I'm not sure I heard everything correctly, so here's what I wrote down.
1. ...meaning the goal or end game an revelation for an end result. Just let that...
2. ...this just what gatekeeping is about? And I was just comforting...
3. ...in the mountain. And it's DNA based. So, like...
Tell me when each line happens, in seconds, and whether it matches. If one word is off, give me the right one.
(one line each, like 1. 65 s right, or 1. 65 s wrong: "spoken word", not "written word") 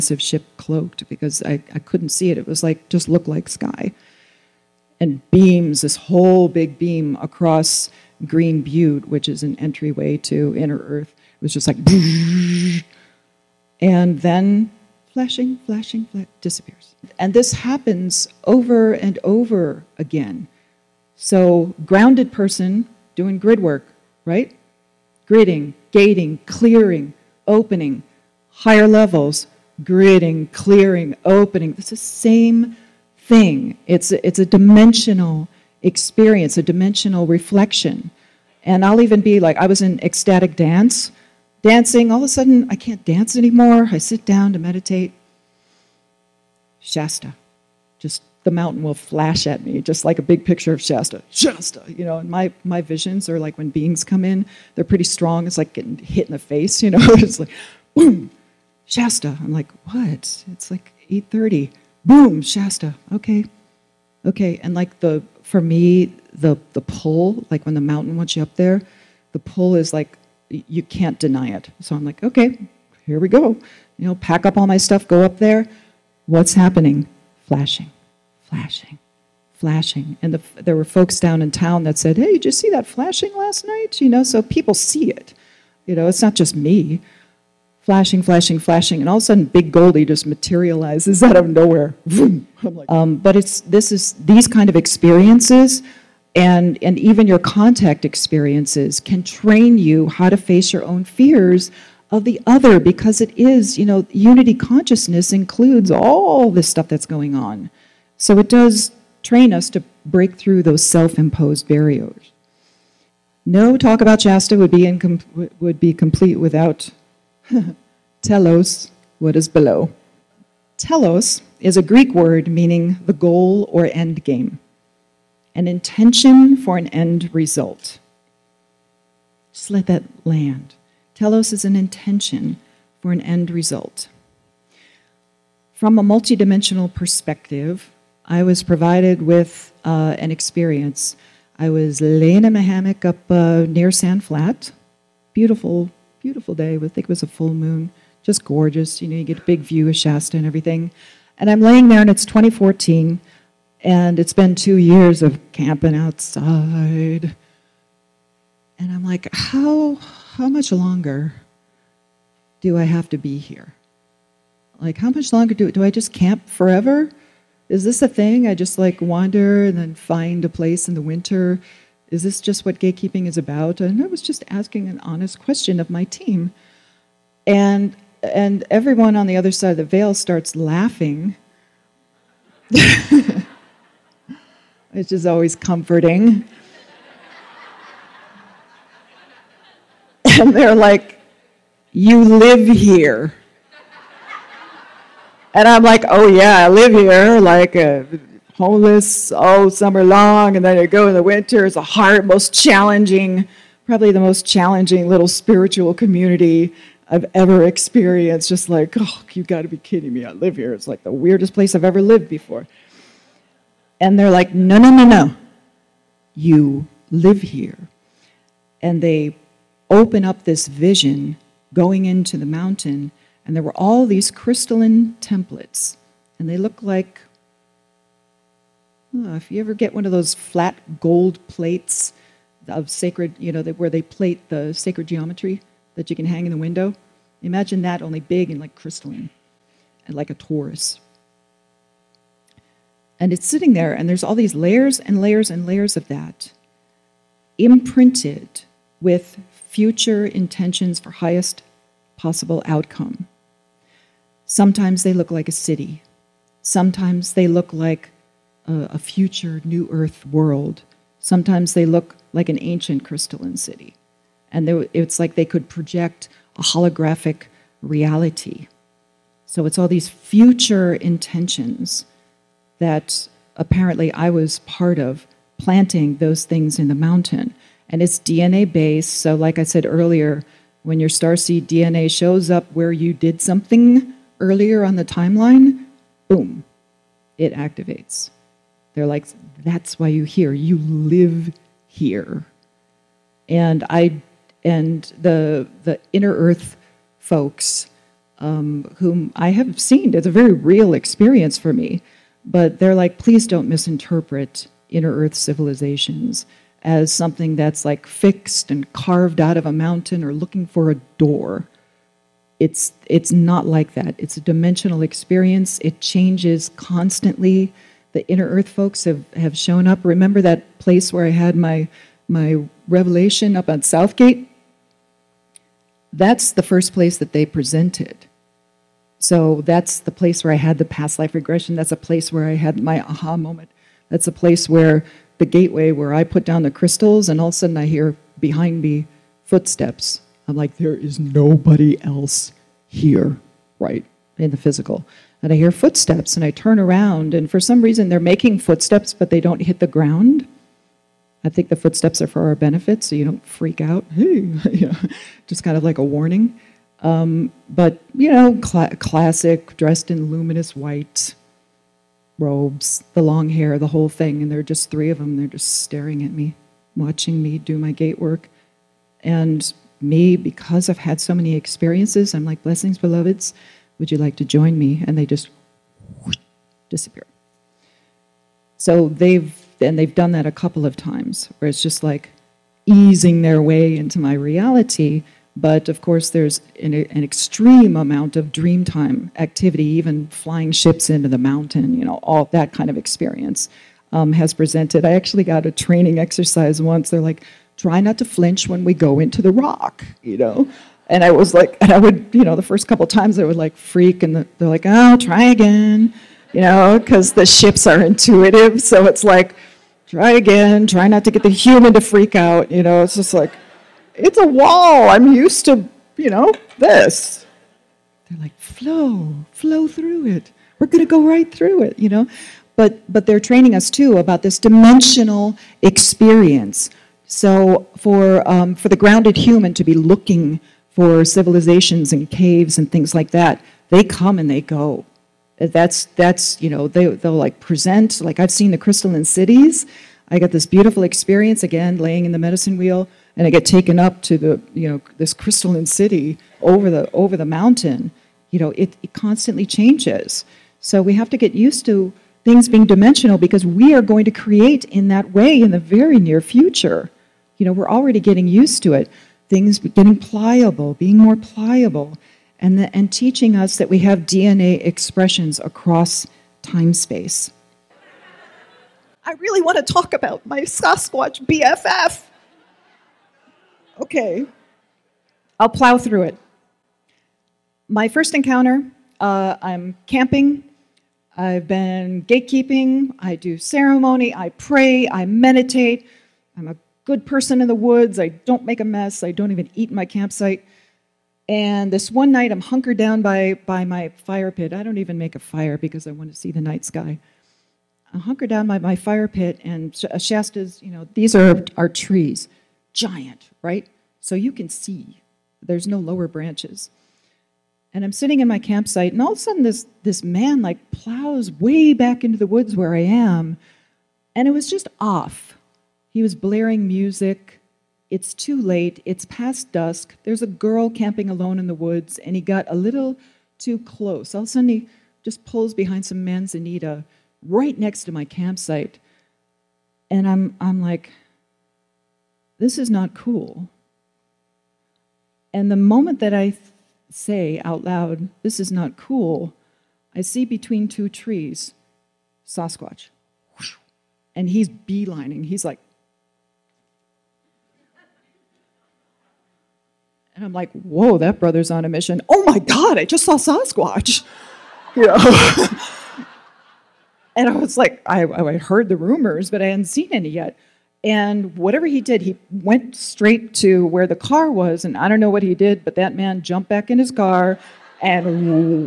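1. 122 s wrong: "intention", not "revelation"
2. 172 s wrong: "asking", not "comforting"
3. 276 s right.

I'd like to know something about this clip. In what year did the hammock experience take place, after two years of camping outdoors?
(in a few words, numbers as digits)
2014.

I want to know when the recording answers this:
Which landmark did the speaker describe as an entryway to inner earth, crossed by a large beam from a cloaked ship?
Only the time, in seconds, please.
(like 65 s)
8 s.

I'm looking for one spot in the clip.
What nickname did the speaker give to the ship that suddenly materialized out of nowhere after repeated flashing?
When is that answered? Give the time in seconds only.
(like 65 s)
89 s.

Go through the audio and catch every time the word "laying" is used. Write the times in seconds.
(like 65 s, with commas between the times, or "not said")
142 s, 151 s, 441 s.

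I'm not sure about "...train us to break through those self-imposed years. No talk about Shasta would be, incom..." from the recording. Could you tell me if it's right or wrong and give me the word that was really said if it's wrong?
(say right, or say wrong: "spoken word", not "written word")
wrong: "barriers", not "years".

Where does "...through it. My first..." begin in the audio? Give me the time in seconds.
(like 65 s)
475 s.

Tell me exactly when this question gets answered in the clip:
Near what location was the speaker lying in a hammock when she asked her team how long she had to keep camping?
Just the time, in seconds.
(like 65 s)
143 s.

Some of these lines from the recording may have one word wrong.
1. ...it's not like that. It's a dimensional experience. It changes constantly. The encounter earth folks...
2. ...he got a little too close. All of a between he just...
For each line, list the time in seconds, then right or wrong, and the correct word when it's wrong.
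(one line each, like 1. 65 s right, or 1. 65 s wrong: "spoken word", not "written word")
1. 313 s wrong: "inner", not "encounter"
2. 522 s wrong: "sudden", not "between".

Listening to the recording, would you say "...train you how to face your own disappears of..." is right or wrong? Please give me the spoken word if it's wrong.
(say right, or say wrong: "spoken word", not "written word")
wrong: "fears", not "disappears".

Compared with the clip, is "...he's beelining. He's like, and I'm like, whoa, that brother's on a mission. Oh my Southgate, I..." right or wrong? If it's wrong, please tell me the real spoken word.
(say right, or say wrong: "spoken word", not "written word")
wrong: "God", not "Southgate".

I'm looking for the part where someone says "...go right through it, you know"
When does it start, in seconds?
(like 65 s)
421 s.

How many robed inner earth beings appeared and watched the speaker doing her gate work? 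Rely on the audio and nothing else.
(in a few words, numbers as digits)
3.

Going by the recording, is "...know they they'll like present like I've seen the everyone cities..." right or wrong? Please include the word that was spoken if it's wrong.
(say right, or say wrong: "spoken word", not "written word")
wrong: "crystalline", not "everyone".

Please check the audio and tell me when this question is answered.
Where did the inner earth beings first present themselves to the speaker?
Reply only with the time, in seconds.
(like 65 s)
323 s.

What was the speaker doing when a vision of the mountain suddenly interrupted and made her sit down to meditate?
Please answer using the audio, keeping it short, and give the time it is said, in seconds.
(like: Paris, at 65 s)
Ecstatic dance, at 40 s.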